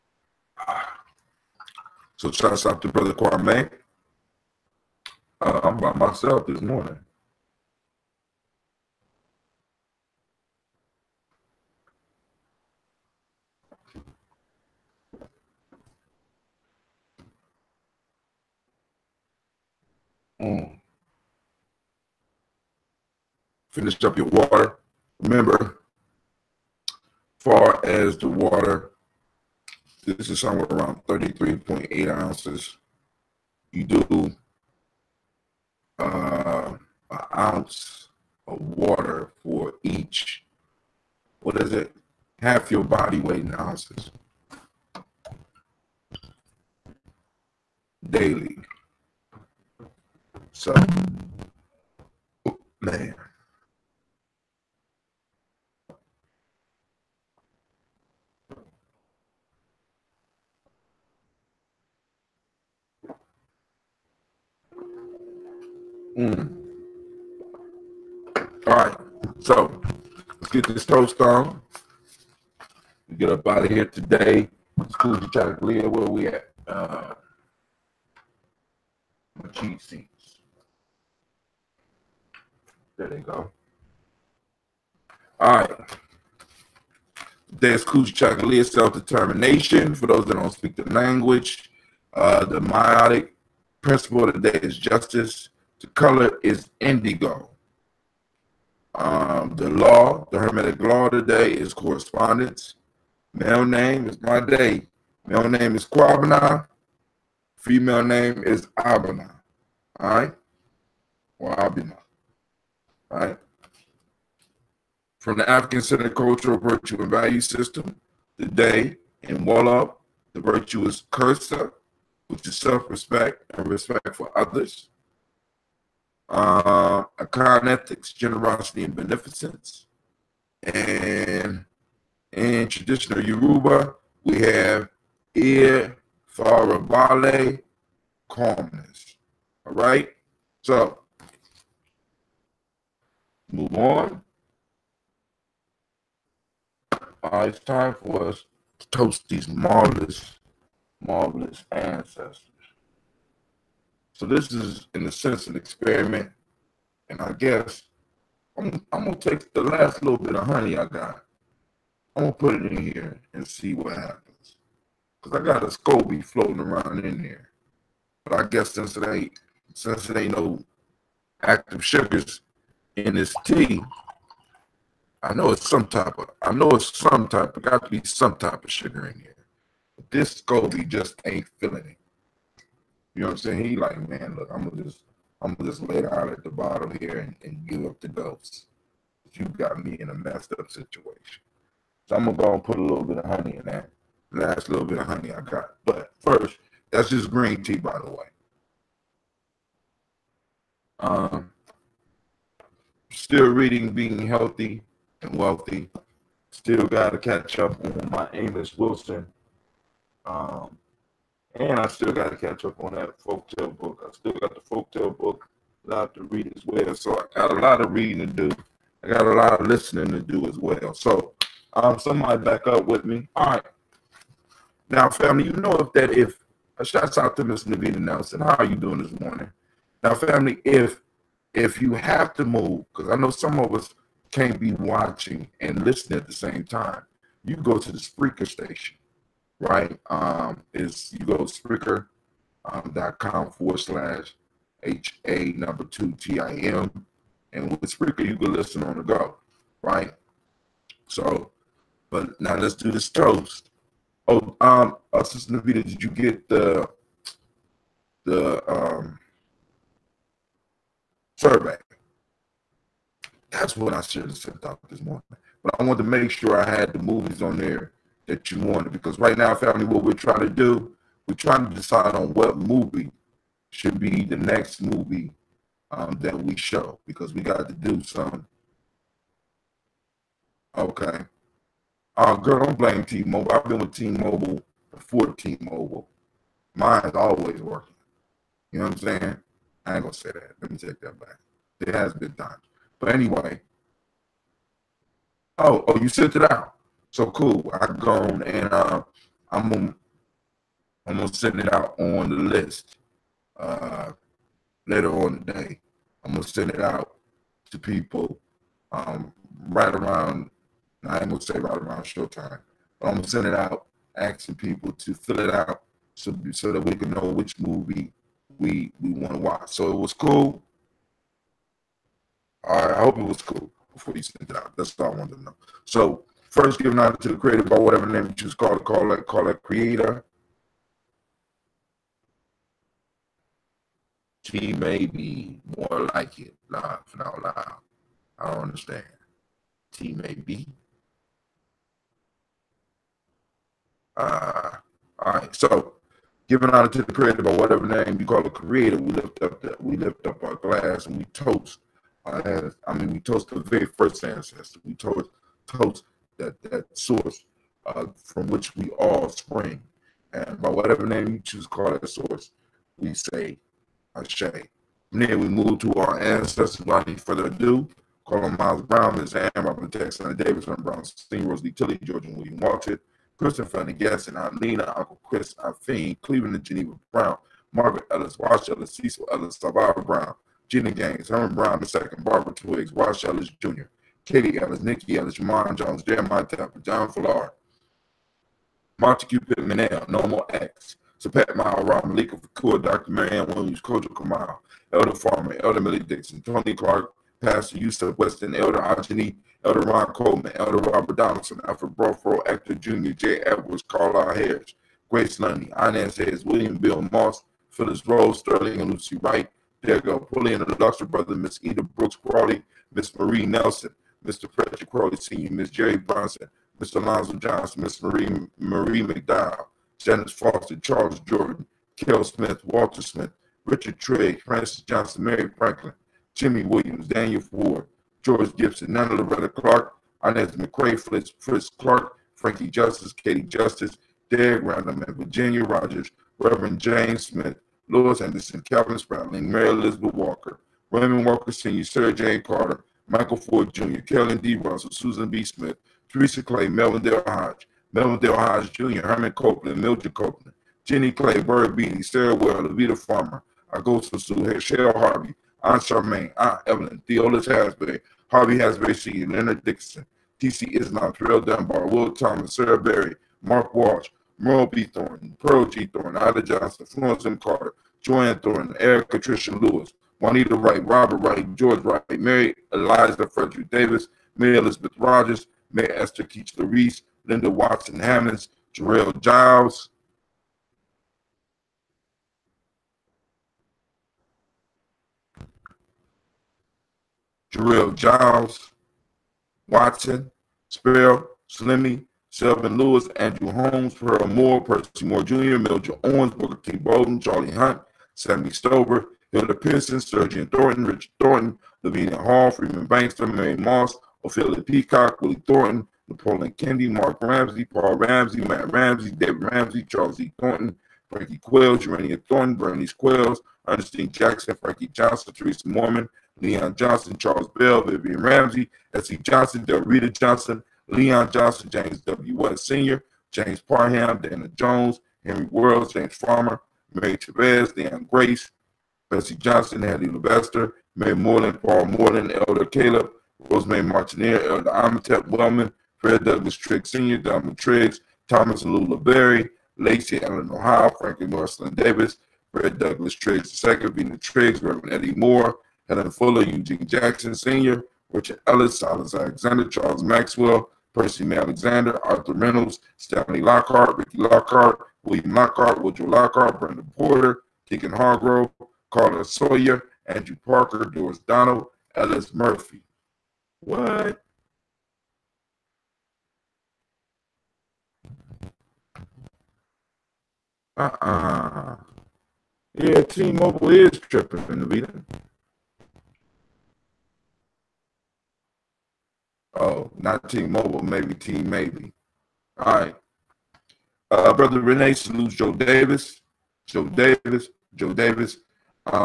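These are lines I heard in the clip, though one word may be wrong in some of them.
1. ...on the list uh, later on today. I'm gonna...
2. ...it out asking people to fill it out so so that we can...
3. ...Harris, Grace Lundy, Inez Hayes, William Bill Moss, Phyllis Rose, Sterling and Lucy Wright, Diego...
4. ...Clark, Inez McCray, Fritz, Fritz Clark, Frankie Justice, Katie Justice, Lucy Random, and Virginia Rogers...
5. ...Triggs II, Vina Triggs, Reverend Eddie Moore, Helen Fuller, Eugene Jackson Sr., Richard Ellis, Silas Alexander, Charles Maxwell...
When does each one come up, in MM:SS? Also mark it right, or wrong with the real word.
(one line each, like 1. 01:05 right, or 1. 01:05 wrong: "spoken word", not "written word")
1. 05:01 right
2. 05:13 right
3. 06:44 right
4. 07:09 wrong: "Derek", not "Lucy"
5. 09:03 right.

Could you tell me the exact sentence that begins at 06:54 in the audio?
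Frederick Crowley Sr., Miss Jerry Bronson, Mr.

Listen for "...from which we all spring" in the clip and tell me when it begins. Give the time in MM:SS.
05:58.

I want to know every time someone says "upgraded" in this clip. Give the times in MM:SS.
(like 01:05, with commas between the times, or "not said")
not said.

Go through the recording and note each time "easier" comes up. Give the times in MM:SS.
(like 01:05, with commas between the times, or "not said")
not said.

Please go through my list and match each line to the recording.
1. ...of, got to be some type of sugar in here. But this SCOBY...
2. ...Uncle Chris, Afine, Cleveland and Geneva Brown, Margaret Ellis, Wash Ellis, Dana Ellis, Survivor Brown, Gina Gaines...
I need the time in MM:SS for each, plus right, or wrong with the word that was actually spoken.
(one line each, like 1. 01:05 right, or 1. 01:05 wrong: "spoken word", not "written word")
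1. 02:57 right
2. 06:14 wrong: "Cecil", not "Dana".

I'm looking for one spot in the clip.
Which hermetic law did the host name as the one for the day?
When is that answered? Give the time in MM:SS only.
01:41.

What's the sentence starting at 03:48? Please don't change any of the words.
How are you doing this morning?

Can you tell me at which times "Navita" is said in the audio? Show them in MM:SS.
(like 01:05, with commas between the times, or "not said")
03:47, 04:15.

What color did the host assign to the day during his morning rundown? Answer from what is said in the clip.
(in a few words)
Indigo.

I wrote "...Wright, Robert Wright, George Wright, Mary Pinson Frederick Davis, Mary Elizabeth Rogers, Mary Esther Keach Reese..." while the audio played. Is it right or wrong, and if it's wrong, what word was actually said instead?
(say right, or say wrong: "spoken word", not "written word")
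wrong: "Eliza", not "Pinson".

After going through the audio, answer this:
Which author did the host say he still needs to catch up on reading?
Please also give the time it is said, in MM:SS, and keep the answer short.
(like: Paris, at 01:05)
Amos Wilson, at 03:28.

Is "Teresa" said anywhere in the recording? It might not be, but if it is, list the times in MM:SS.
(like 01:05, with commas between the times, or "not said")
07:26, 08:35.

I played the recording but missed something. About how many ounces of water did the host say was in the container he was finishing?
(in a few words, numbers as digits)
33.8.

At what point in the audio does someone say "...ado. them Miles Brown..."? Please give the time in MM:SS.
06:07.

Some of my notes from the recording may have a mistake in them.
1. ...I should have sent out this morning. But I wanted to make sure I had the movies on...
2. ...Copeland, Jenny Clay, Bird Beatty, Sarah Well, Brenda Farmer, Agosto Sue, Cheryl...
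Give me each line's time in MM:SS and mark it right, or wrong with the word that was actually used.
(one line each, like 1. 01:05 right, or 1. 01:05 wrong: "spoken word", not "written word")
1. 04:23 right
2. 07:30 wrong: "Levita", not "Brenda".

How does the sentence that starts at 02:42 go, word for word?
I'm gonna put it in here and see what happens, cause I got a scoby floating around in there.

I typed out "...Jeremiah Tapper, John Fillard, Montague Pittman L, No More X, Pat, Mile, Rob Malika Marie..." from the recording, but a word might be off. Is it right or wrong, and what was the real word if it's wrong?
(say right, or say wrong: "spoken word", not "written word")
wrong: "Fakua", not "Marie".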